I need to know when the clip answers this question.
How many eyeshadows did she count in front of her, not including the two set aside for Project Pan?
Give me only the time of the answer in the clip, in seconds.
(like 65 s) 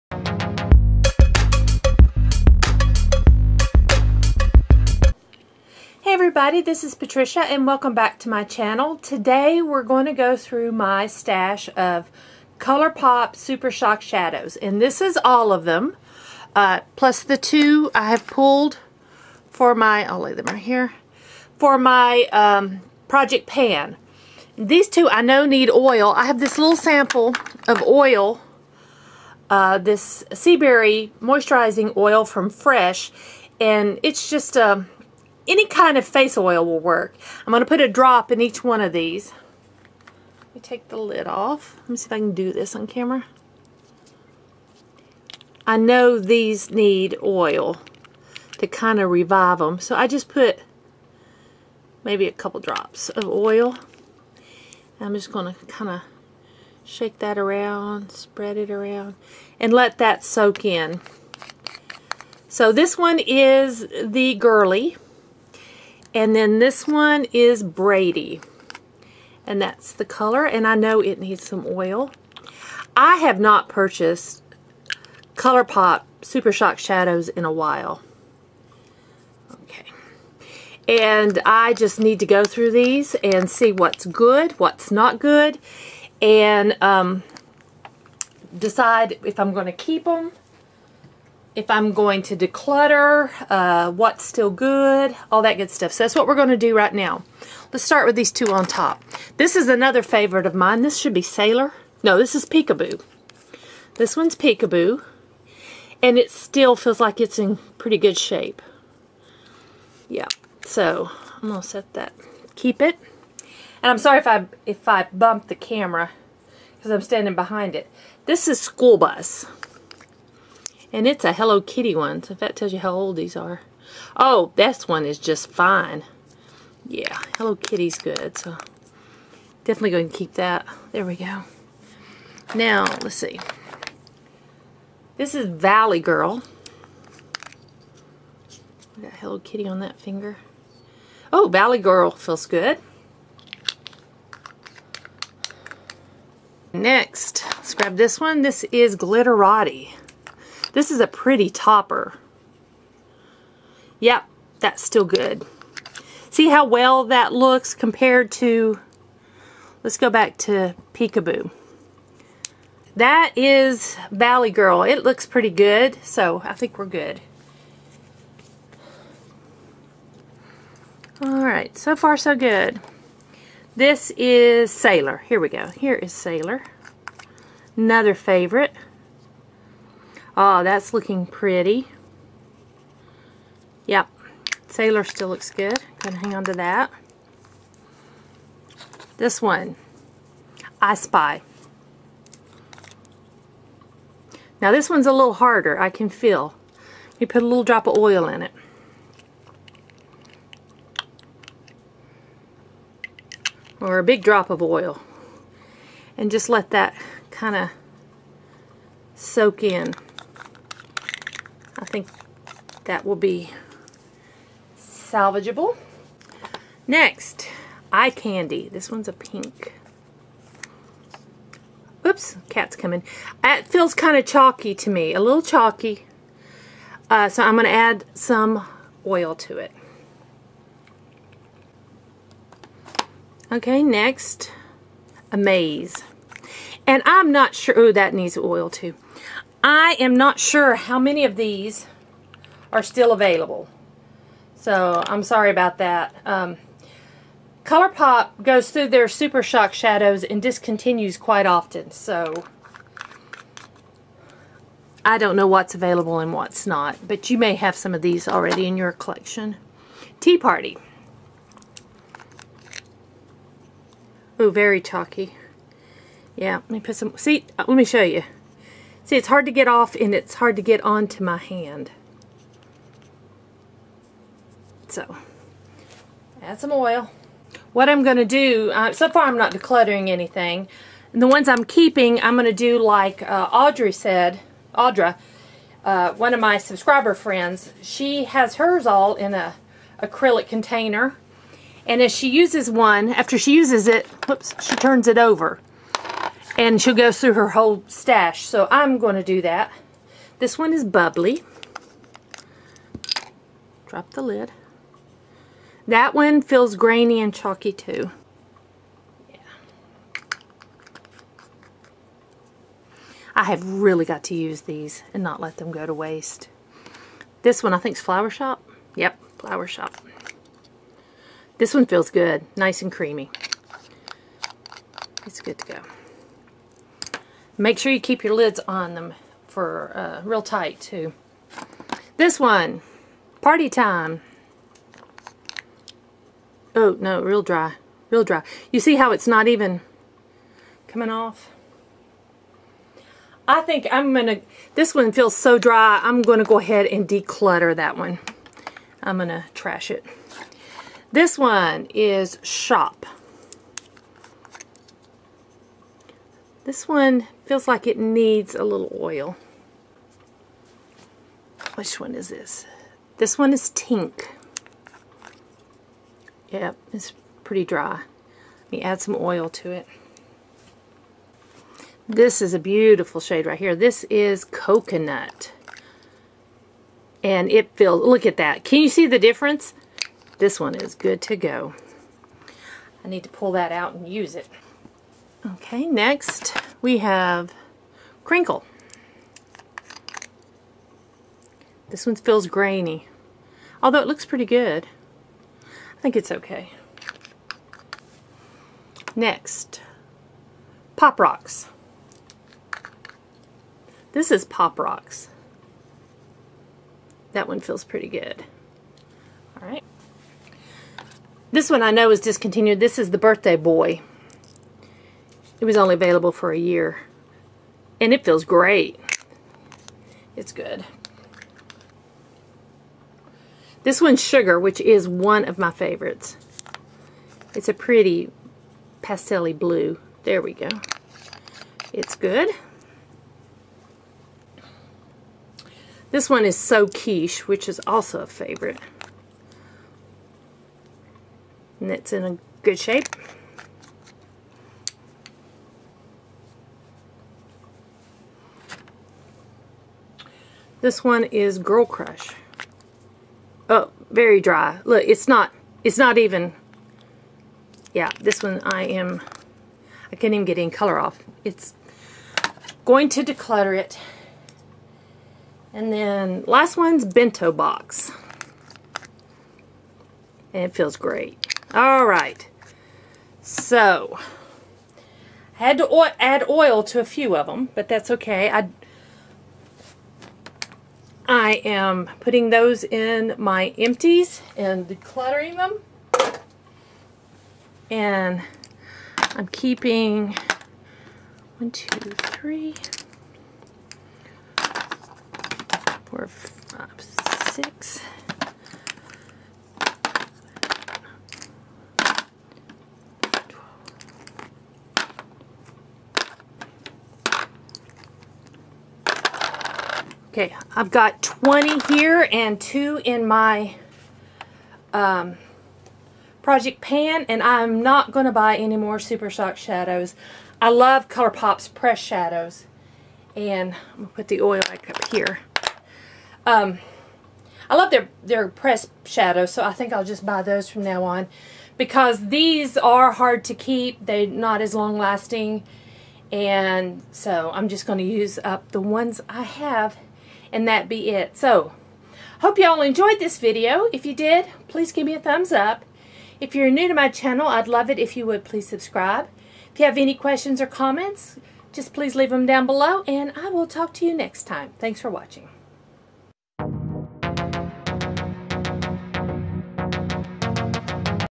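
511 s.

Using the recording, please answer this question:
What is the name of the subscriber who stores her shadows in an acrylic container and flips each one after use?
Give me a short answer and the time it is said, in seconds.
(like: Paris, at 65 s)
Audra, at 284 s.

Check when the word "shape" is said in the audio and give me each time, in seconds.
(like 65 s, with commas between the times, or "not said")
108 s, 442 s.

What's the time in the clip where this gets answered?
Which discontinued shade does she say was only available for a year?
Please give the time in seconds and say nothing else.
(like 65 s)
413 s.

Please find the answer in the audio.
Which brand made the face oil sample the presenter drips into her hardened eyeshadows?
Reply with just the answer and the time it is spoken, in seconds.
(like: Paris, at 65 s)
Fresh, at 32 s.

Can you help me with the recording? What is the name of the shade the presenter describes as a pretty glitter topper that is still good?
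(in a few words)
Glitterati.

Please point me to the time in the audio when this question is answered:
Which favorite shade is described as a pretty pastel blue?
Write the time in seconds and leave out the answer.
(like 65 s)
424 s.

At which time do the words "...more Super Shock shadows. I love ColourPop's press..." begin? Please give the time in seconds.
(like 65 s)
518 s.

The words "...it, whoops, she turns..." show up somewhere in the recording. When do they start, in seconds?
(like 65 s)
293 s.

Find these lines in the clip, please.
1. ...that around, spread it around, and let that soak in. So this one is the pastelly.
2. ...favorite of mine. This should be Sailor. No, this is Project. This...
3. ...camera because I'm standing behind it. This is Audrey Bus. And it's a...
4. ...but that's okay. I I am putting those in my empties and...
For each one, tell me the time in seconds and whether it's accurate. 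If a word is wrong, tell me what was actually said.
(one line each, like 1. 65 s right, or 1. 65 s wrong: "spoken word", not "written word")
1. 57 s wrong: "girly", not "pastelly"
2. 100 s wrong: "Peekaboo", not "Project"
3. 115 s wrong: "School", not "Audrey"
4. 477 s right.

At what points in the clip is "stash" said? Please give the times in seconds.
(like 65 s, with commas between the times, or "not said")
11 s, 297 s.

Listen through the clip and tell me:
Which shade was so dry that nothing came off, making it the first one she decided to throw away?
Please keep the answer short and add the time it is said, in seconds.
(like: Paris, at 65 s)
Party Time, at 333 s.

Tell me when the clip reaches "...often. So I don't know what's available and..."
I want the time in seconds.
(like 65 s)
251 s.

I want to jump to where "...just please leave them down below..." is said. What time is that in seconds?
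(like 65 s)
551 s.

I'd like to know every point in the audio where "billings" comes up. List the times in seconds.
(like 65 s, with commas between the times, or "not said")
not said.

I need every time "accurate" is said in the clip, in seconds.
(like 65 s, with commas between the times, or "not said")
not said.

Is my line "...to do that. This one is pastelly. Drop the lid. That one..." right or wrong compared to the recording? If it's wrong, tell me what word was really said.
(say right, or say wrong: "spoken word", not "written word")
wrong: "bubbly", not "pastelly".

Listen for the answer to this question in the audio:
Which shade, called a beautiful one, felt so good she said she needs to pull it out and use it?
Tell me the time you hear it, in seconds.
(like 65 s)
374 s.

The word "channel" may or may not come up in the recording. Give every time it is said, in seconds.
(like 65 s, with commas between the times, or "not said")
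8 s, 547 s.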